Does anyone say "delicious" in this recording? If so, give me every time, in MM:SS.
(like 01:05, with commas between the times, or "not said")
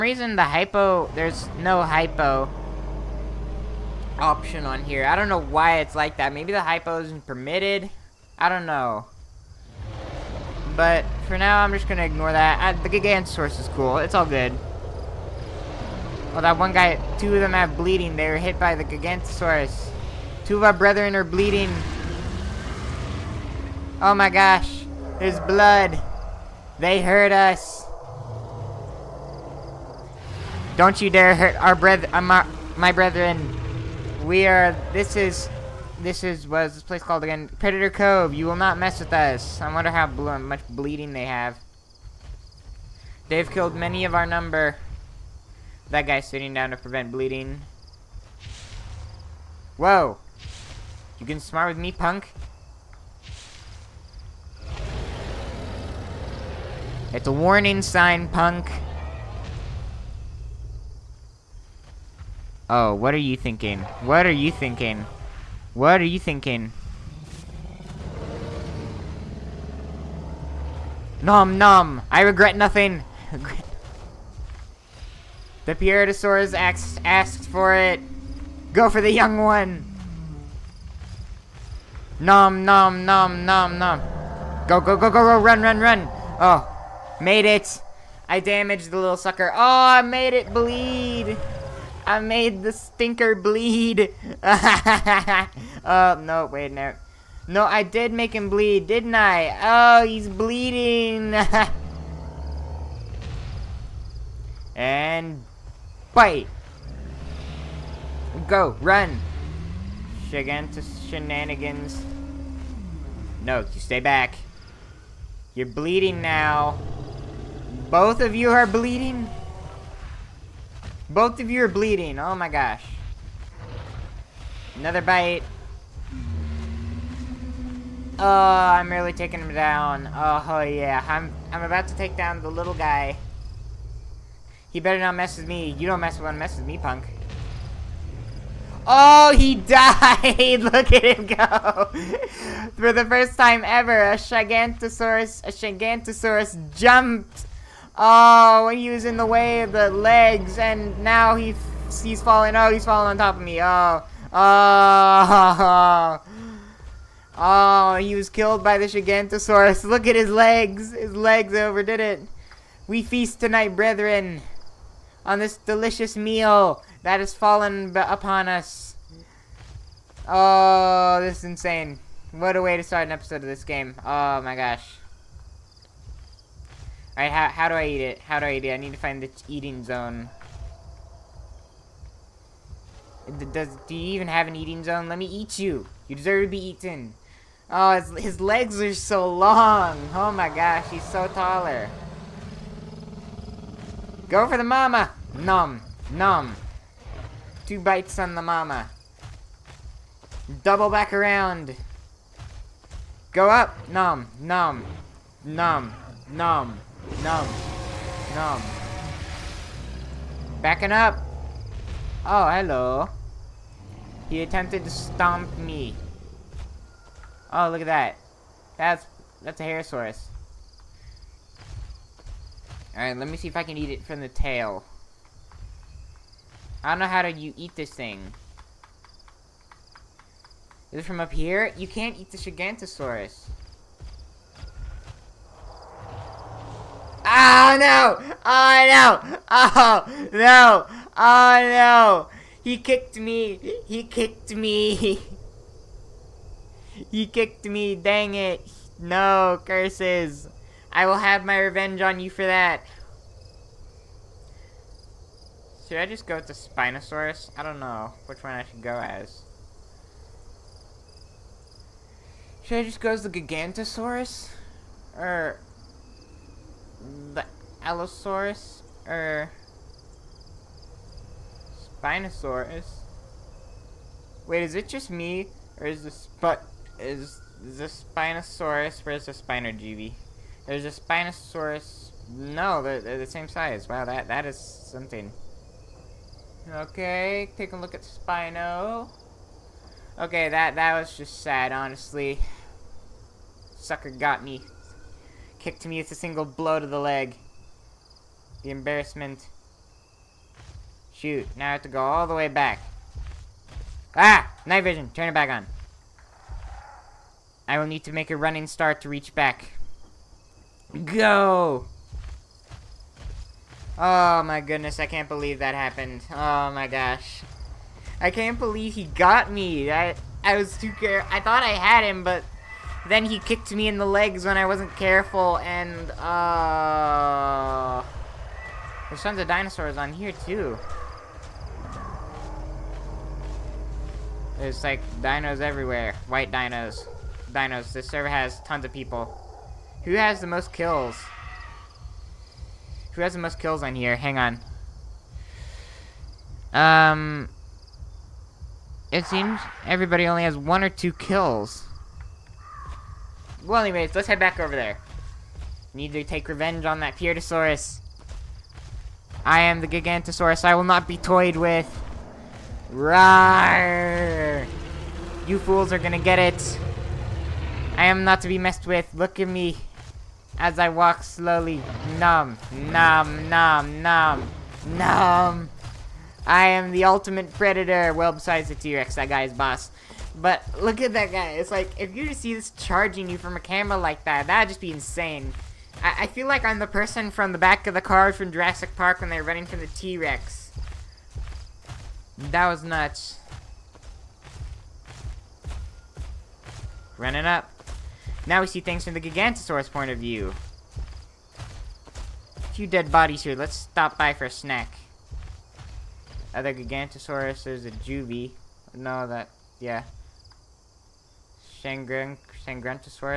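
02:45.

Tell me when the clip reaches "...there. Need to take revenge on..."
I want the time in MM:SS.
05:54.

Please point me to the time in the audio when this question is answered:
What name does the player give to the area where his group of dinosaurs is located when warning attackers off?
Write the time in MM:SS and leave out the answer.
00:37.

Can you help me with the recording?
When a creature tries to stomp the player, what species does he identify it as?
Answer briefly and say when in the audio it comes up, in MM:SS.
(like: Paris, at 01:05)
Harosaurus, at 03:39.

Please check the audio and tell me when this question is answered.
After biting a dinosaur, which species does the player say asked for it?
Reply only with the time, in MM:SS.
01:15.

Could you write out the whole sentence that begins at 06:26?
I, I feel like I'm the person from the back of the car from Jurassic Park when they're running from the T-Rex.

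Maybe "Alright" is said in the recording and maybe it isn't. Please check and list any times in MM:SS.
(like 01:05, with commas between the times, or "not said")
02:57, 03:42.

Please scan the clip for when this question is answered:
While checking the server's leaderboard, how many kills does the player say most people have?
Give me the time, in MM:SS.
05:50.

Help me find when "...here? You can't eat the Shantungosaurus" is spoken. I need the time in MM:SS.
03:51.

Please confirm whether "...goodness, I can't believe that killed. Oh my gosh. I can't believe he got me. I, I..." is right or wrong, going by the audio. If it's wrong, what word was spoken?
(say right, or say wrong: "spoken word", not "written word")
wrong: "happened", not "killed".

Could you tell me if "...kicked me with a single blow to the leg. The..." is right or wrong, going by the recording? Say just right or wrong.
right.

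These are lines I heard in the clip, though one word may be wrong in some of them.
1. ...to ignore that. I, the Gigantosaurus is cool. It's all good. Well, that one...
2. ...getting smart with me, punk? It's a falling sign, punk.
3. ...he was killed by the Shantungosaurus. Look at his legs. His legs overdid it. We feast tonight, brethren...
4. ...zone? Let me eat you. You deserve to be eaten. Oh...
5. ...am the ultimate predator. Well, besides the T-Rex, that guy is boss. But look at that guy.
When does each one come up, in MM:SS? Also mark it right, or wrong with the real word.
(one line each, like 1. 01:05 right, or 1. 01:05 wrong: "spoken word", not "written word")
1. 00:11 right
2. 00:51 wrong: "warning", not "falling"
3. 02:37 right
4. 03:04 right
5. 06:16 right.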